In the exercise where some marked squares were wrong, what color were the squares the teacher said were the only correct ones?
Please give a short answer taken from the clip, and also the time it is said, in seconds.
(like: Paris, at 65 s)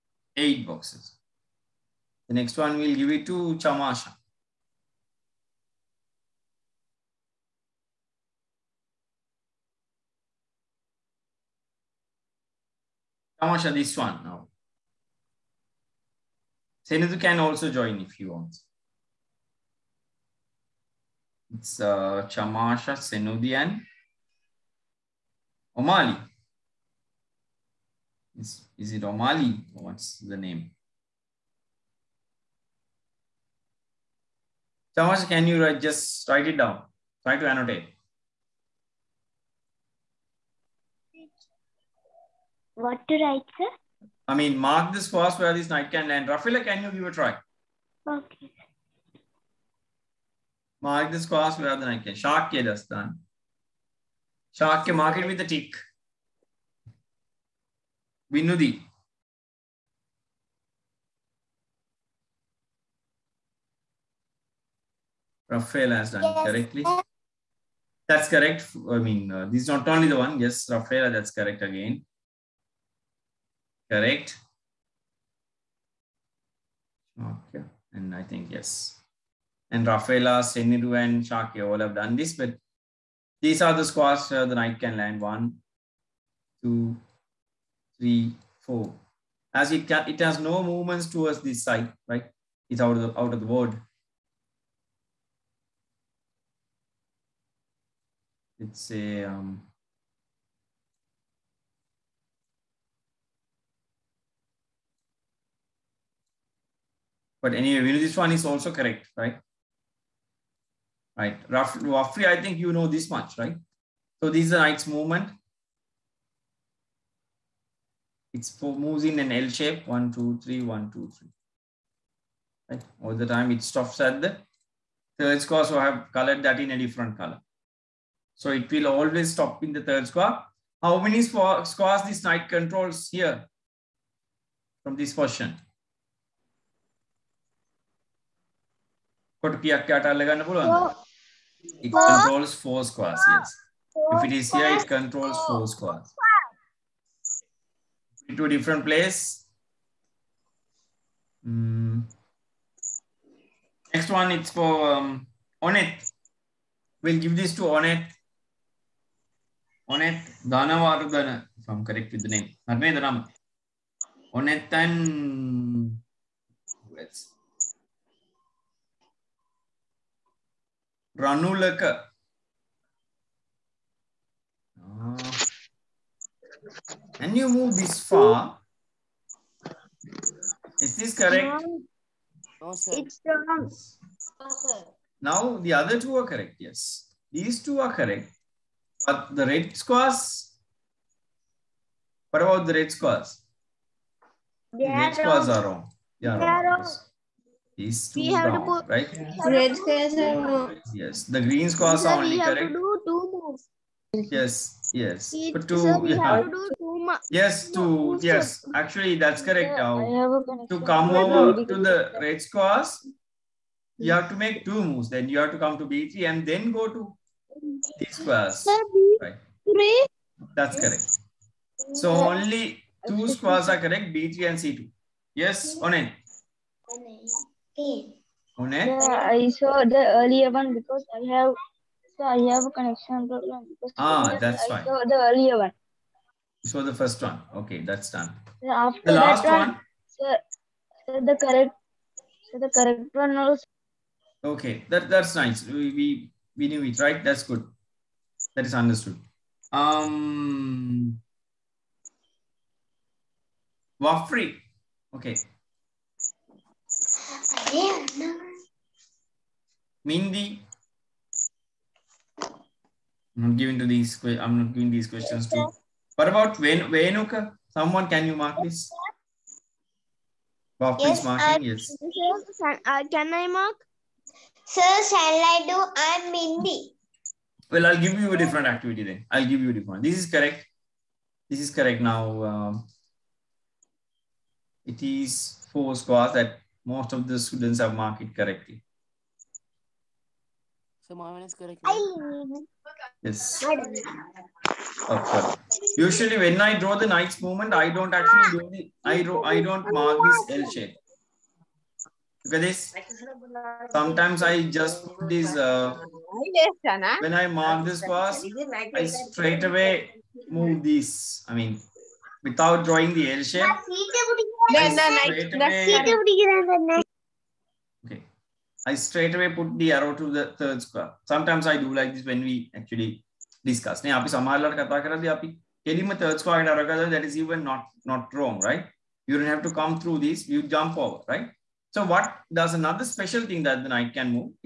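green, at 201 s.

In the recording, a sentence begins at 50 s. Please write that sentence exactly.
Mark this cross where the knight can.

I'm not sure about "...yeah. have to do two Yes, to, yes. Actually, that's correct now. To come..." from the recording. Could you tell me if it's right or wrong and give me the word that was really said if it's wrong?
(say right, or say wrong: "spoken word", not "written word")
right.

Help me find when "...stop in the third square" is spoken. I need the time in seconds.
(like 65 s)
129 s.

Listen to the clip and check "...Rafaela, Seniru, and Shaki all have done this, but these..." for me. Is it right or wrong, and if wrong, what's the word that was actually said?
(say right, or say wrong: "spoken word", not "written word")
right.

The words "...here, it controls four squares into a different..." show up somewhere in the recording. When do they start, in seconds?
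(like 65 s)
144 s.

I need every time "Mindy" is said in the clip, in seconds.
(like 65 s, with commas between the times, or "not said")
260 s, 276 s.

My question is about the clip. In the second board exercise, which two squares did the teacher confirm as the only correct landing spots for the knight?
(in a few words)
B3 and C2.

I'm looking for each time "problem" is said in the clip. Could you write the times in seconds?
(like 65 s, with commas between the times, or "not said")
233 s.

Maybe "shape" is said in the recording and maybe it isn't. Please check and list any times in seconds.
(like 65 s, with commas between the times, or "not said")
119 s, 300 s, 313 s.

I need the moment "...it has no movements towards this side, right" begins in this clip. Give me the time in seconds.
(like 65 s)
90 s.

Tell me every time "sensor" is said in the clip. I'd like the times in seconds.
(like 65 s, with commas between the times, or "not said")
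not said.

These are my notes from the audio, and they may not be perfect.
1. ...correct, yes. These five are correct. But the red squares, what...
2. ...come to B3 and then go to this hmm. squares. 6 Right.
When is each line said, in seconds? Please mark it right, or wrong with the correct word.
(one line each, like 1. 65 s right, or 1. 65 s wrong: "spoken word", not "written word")
1. 186 s wrong: "two", not "five"
2. 215 s wrong: "3", not "6".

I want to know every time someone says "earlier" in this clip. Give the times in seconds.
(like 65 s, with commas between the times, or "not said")
230 s, 235 s.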